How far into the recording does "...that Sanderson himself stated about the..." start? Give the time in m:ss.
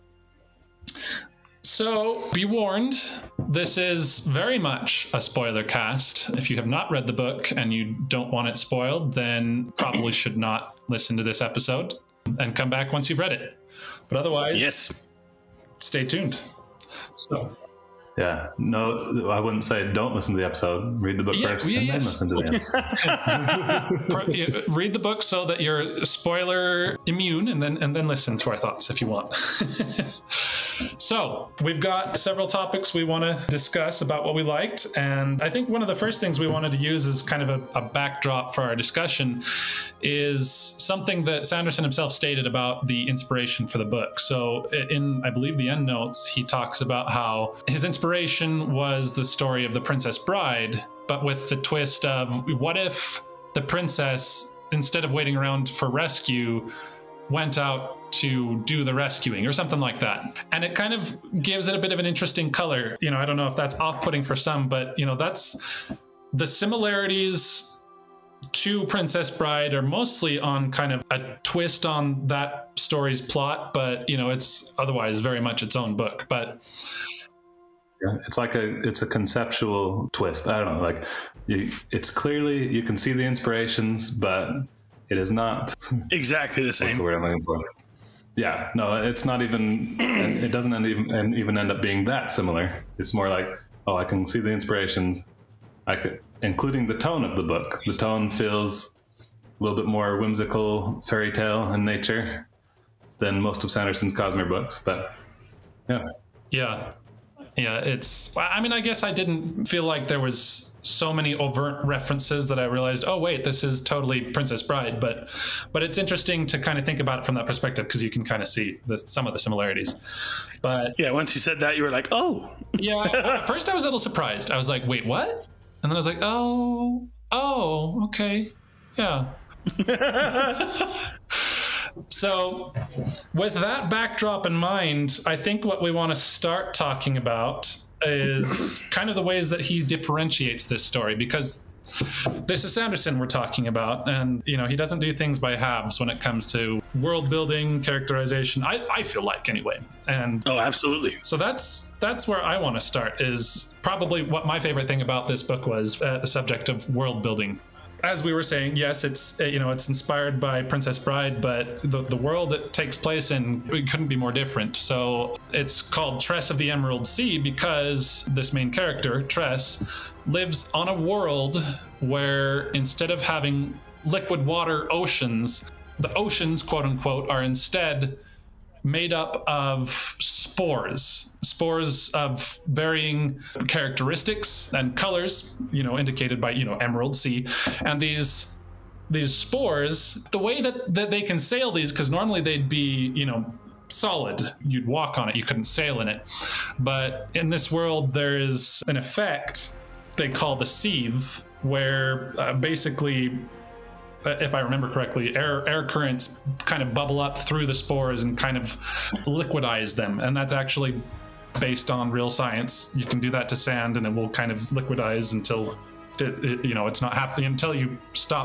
0:41.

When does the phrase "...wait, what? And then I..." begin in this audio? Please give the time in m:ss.
2:04.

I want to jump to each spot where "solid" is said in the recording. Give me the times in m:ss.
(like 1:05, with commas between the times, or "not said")
3:13.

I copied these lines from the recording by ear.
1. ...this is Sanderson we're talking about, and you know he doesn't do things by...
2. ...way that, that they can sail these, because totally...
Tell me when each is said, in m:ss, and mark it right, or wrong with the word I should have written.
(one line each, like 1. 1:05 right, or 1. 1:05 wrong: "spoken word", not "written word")
1. 2:22 right
2. 3:10 wrong: "normally", not "totally".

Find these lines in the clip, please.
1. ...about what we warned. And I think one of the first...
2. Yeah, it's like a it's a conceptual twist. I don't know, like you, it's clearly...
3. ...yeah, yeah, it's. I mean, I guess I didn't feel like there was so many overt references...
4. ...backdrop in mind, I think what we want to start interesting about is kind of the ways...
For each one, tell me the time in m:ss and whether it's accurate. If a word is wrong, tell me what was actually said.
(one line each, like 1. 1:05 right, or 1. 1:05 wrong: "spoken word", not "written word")
1. 0:34 wrong: "liked", not "warned"
2. 1:18 right
3. 1:46 right
4. 2:13 wrong: "talking", not "interesting".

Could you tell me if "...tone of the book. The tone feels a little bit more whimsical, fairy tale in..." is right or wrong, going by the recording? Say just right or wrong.
right.